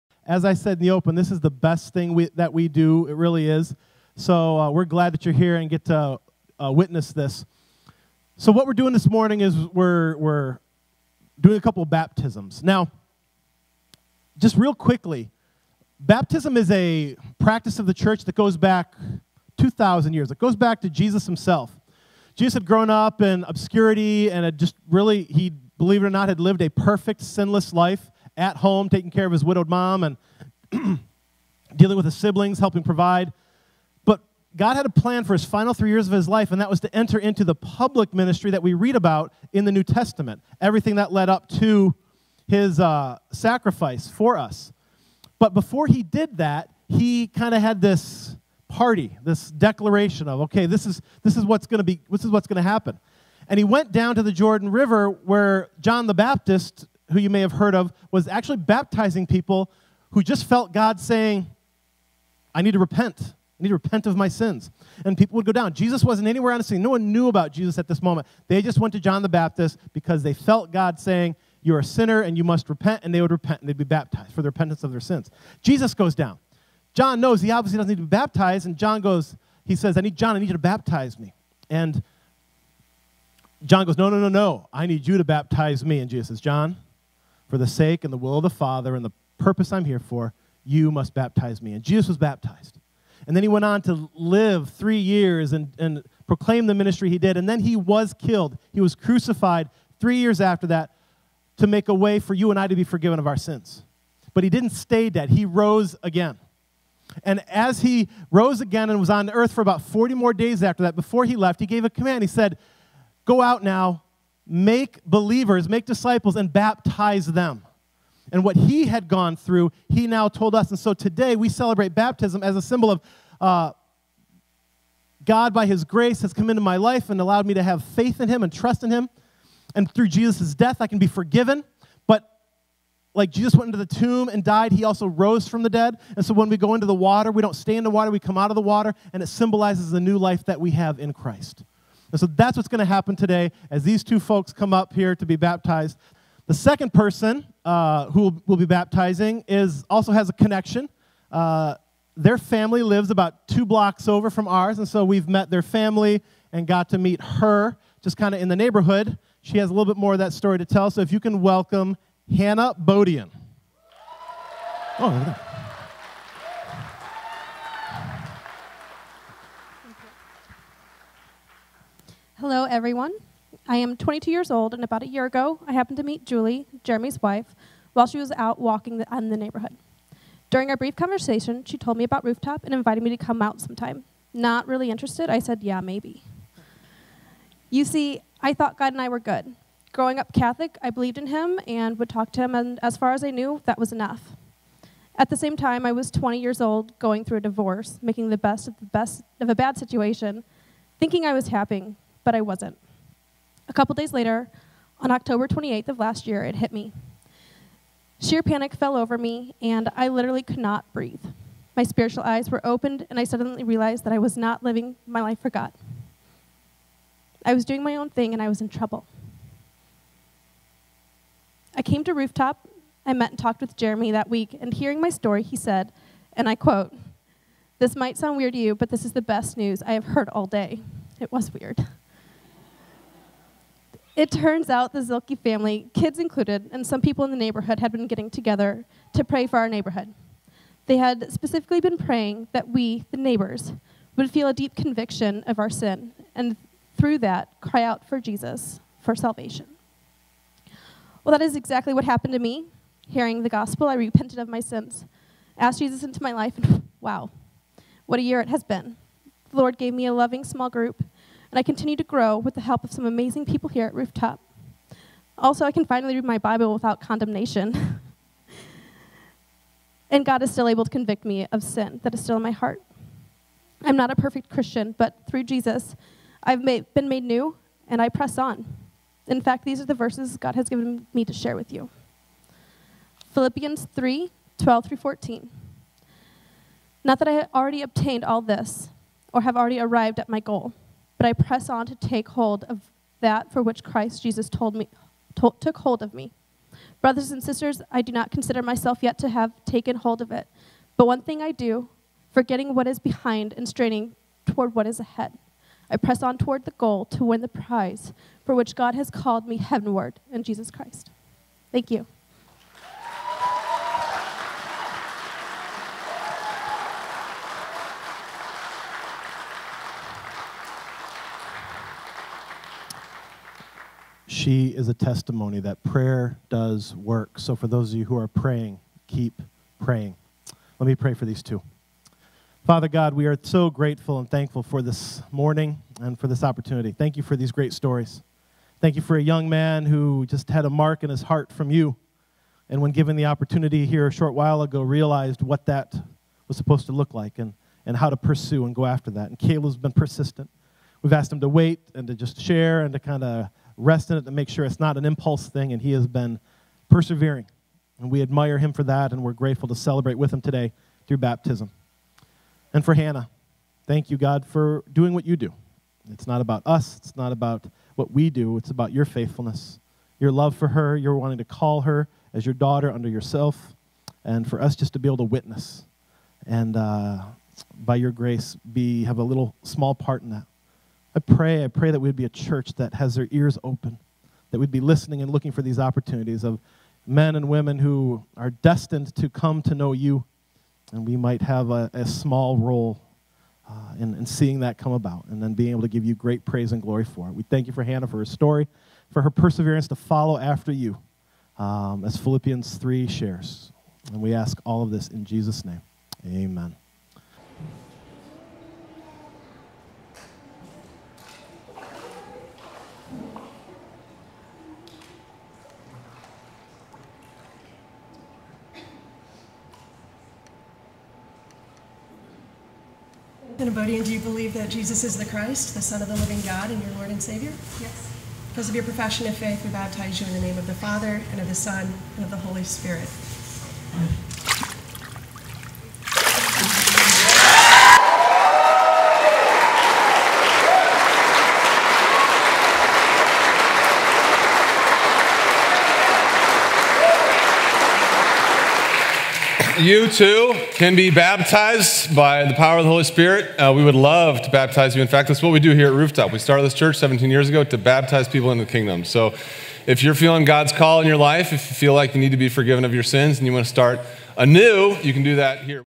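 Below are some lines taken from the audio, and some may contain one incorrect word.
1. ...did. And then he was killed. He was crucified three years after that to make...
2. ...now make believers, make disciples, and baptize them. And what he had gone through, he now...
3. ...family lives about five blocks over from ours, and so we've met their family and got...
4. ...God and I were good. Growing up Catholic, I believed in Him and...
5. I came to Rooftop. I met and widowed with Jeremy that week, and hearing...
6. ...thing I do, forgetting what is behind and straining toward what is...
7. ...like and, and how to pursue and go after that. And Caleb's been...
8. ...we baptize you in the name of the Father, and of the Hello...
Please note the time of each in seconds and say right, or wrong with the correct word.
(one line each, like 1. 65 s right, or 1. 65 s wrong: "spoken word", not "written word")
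1. 97 s right
2. 113 s right
3. 152 s wrong: "two", not "five"
4. 188 s right
5. 221 s wrong: "talked", not "widowed"
6. 301 s right
7. 347 s right
8. 429 s wrong: "Son", not "Hello".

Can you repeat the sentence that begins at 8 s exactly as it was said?
So what we're doing this morning is we're, we're doing a couple baptisms.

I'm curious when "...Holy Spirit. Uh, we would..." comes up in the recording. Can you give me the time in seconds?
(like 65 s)
452 s.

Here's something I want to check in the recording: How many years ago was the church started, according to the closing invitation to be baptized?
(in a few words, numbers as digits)
17.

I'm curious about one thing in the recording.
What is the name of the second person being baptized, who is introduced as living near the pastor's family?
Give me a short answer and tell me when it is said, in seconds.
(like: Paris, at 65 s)
Hannah Bodian, at 162 s.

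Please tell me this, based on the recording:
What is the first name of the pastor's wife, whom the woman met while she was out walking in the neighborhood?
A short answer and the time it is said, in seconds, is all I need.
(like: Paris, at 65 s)
Julie, at 176 s.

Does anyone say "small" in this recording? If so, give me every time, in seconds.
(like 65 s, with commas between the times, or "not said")
260 s, 379 s, 392 s.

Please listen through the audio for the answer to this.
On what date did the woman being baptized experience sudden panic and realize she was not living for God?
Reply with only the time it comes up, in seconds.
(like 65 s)
205 s.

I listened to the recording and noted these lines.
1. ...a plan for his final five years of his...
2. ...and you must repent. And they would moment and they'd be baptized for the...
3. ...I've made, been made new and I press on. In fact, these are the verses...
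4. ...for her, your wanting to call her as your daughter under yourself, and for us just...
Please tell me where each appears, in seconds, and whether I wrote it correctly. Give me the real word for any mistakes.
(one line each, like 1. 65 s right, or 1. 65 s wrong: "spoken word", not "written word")
1. 34 s wrong: "three", not "five"
2. 72 s wrong: "repent", not "moment"
3. 276 s right
4. 370 s right.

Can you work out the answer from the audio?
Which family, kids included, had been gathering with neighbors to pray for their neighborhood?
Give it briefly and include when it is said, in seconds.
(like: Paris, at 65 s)
The Zilke family, at 234 s.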